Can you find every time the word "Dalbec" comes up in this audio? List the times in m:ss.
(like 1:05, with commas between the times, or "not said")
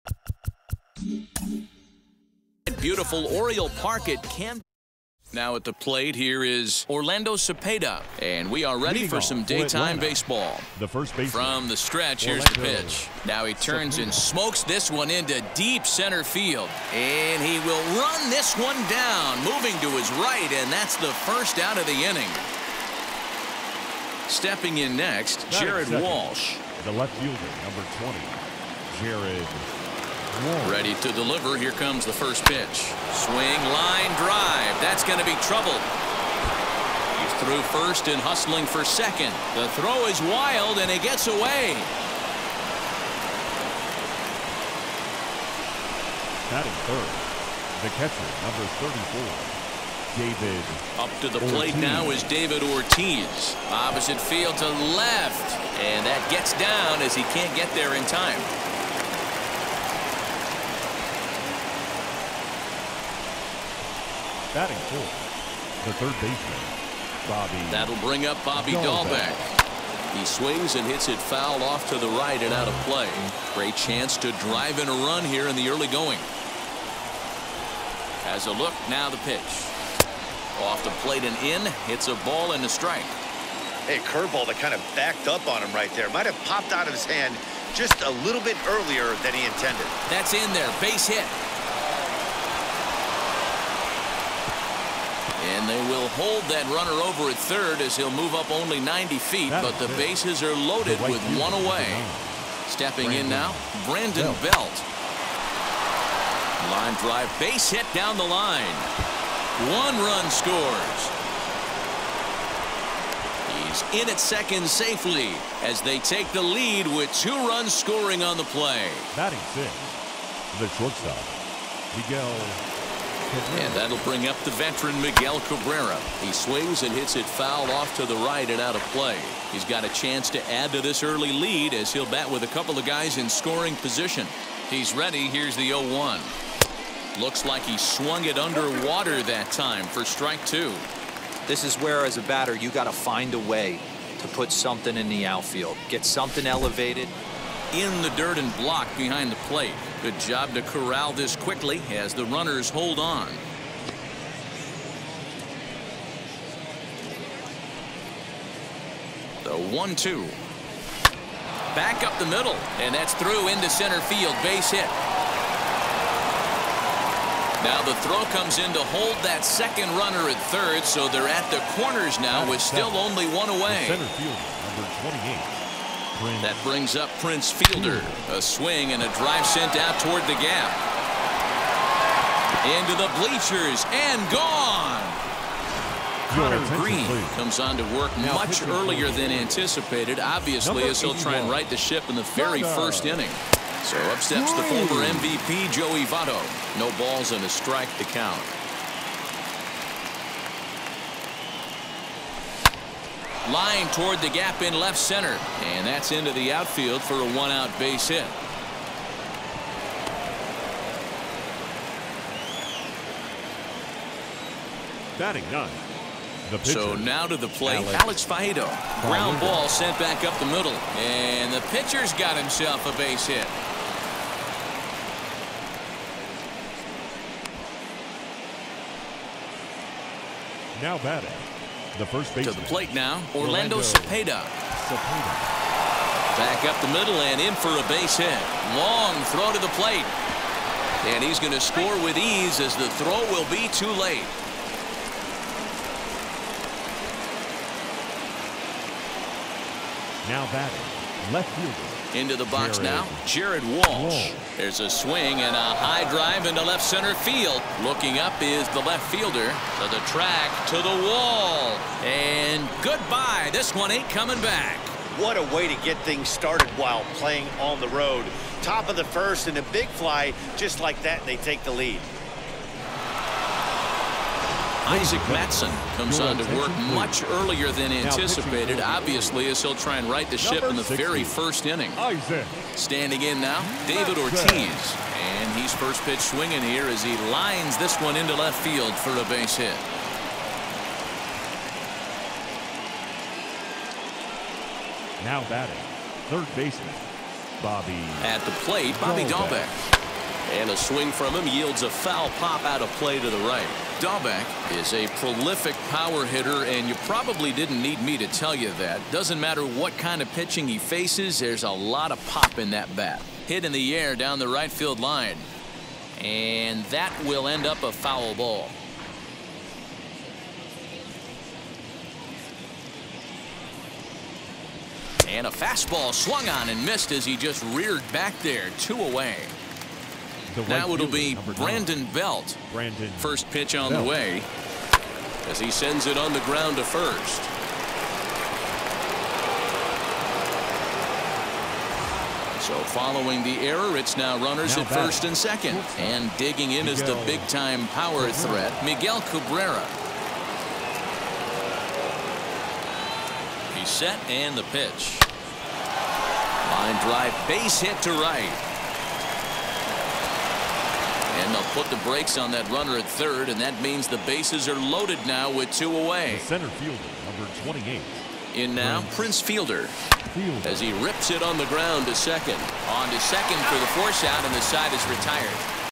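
1:08, 4:59, 5:04.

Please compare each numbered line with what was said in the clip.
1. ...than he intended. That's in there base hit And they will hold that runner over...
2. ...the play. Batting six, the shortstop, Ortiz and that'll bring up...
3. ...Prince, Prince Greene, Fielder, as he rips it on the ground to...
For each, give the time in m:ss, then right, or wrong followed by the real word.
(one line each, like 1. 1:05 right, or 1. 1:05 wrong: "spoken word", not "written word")
1. 1:29 right
2. 1:58 wrong: "Miguel", not "Ortiz"
3. 6:09 wrong: "Fielder", not "Greene".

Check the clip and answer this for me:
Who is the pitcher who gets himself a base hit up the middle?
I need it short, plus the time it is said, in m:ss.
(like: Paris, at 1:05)
Alex Faedo, at 3:38.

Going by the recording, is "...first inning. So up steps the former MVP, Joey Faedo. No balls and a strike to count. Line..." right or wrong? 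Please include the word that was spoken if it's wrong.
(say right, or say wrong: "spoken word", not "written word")
wrong: "Votto", not "Faedo".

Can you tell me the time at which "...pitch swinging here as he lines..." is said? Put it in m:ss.
4:46.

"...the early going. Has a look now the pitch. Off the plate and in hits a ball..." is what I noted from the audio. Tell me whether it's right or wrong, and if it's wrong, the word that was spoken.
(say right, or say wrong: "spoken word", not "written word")
right.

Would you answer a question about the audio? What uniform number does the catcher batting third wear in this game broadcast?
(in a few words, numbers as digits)
34.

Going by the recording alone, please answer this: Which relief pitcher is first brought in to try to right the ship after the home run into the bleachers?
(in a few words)
Conner Greene.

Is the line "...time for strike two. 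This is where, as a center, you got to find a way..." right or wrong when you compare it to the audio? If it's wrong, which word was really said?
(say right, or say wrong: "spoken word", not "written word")
wrong: "batter", not "center".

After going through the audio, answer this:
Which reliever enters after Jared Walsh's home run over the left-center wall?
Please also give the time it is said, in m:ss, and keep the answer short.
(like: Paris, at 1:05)
Isaac Mattson, at 4:34.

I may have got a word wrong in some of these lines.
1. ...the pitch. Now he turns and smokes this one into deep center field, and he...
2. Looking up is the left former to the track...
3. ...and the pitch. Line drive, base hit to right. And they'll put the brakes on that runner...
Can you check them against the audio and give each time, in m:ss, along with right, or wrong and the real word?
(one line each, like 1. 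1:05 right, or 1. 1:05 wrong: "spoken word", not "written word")
1. 0:12 right
2. 4:17 wrong: "fielder", not "former"
3. 5:54 right.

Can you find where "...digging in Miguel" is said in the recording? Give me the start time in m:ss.
5:46.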